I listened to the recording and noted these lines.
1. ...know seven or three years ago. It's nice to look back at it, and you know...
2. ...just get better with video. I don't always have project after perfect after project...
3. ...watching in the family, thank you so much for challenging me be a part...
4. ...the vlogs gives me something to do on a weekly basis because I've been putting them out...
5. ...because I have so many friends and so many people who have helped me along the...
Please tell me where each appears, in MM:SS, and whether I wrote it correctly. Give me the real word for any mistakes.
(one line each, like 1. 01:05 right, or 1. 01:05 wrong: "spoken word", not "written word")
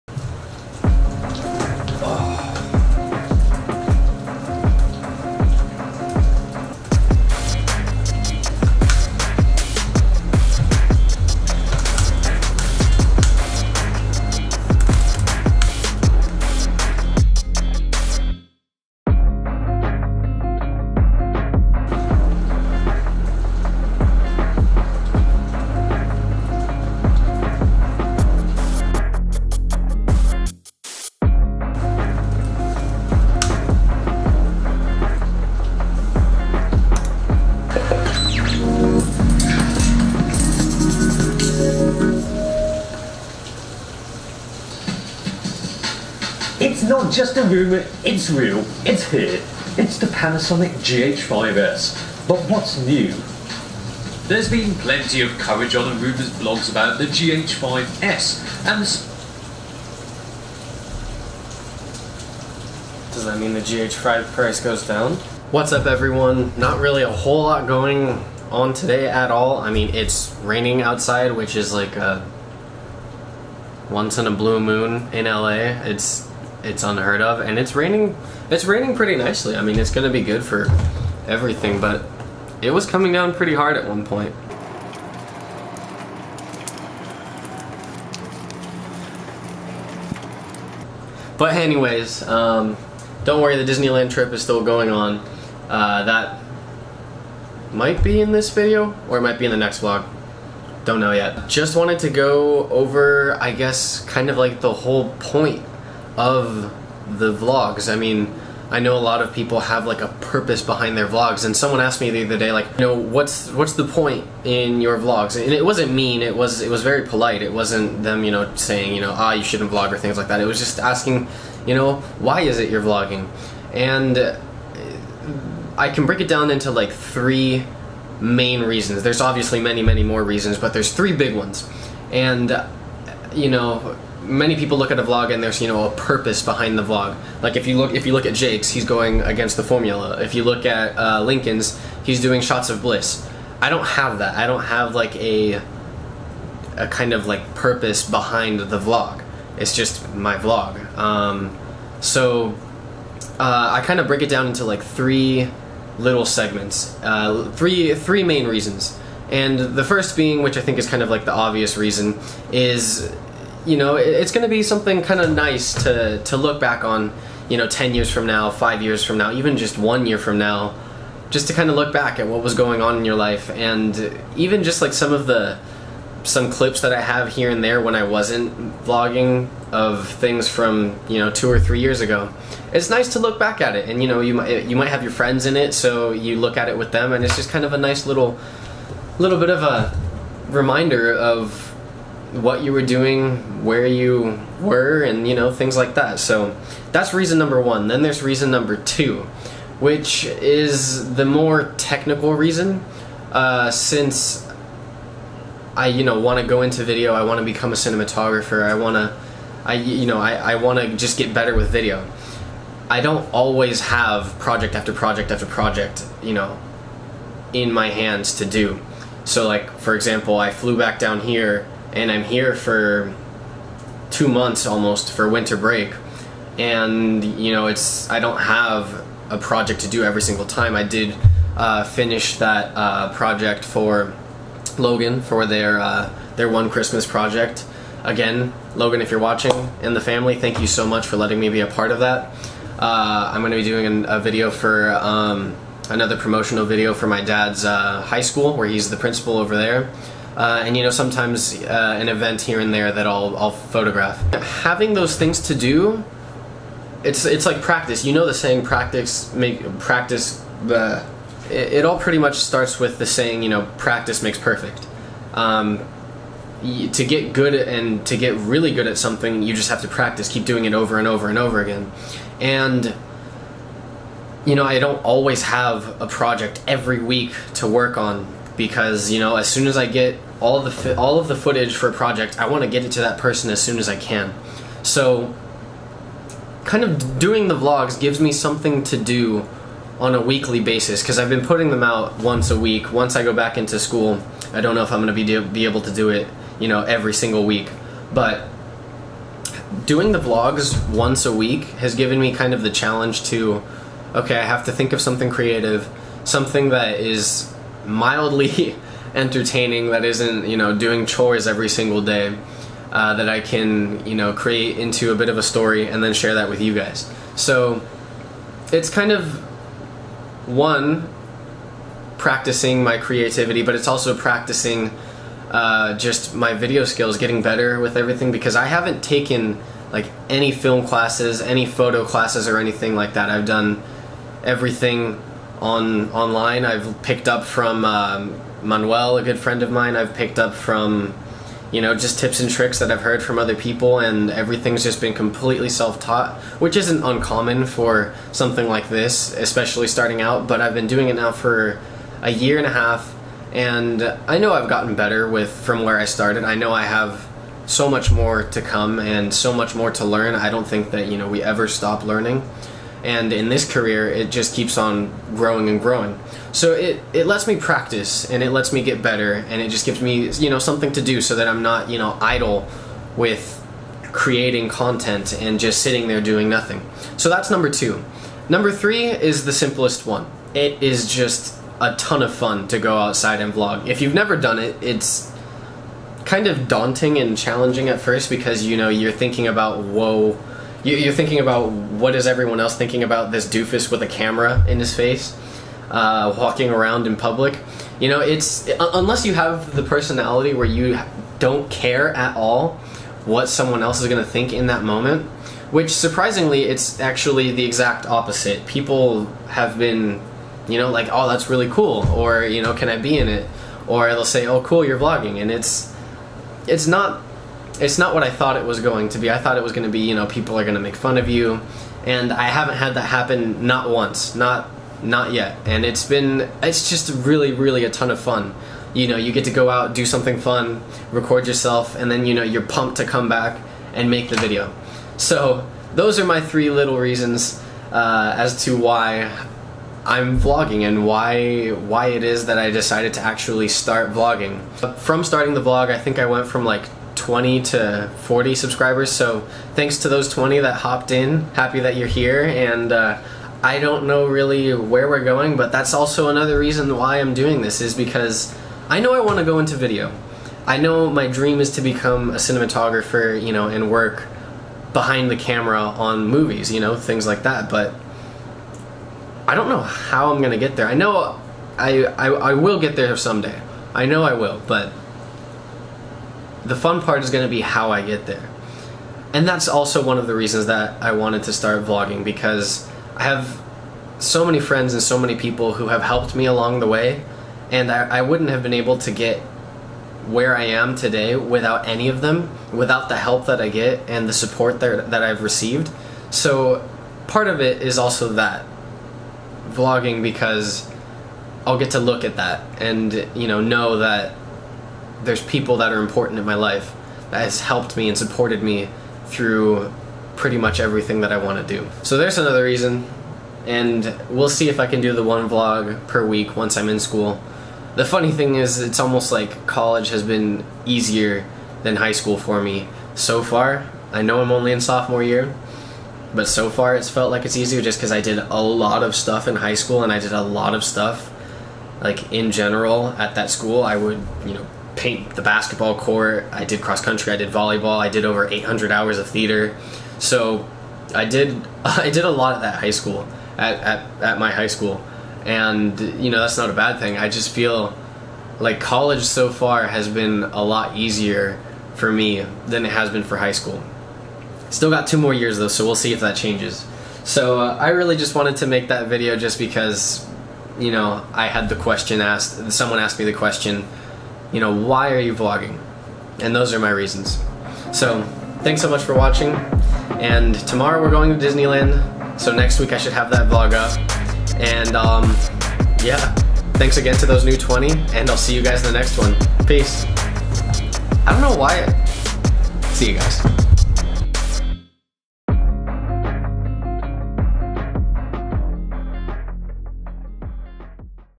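1. 03:01 wrong: "two", not "seven"
2. 03:30 wrong: "project", not "perfect"
3. 03:59 wrong: "letting", not "challenging"
4. 04:47 right
5. 08:02 right.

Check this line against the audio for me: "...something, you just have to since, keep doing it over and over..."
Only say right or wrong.
wrong.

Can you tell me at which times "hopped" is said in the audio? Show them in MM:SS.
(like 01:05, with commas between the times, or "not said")
07:30.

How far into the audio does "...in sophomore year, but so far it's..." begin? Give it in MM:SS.
08:44.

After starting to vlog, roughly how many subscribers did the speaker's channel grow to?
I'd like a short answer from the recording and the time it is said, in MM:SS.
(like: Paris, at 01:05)
40, at 07:28.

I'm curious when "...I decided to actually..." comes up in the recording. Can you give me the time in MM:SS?
07:22.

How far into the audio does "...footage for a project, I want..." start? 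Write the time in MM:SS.
04:41.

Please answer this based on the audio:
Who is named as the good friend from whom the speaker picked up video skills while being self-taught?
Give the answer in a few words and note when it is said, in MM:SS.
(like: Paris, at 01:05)
Manuel, at 05:38.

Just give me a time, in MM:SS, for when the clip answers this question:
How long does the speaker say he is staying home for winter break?
03:44.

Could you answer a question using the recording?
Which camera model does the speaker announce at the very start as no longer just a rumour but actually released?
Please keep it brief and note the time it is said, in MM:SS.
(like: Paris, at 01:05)
Panasonic GH5S, at 00:50.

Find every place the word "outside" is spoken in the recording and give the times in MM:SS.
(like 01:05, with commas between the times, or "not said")
01:10, 06:22.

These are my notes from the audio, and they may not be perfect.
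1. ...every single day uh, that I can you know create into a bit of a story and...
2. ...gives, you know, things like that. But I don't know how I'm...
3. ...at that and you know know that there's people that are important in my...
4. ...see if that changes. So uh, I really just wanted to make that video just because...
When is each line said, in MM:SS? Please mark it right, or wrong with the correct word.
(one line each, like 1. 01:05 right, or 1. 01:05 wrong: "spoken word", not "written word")
1. 05:11 right
2. 07:46 wrong: "movies", not "gives"
3. 08:22 right
4. 09:15 right.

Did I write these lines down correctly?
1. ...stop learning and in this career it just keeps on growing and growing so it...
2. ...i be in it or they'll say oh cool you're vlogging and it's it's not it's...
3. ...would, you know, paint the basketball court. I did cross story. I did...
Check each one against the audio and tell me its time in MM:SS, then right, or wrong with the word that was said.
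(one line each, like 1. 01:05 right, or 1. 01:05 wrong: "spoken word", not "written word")
1. 06:01 right
2. 06:52 right
3. 08:53 wrong: "country", not "story".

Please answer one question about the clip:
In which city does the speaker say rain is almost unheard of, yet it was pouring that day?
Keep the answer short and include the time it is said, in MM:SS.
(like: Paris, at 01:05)
LA, at 01:15.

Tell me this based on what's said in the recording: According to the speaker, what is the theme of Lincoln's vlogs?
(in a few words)
Shots of bliss.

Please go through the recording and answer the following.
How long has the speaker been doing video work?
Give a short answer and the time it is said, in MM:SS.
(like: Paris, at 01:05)
A year and a half, at 05:52.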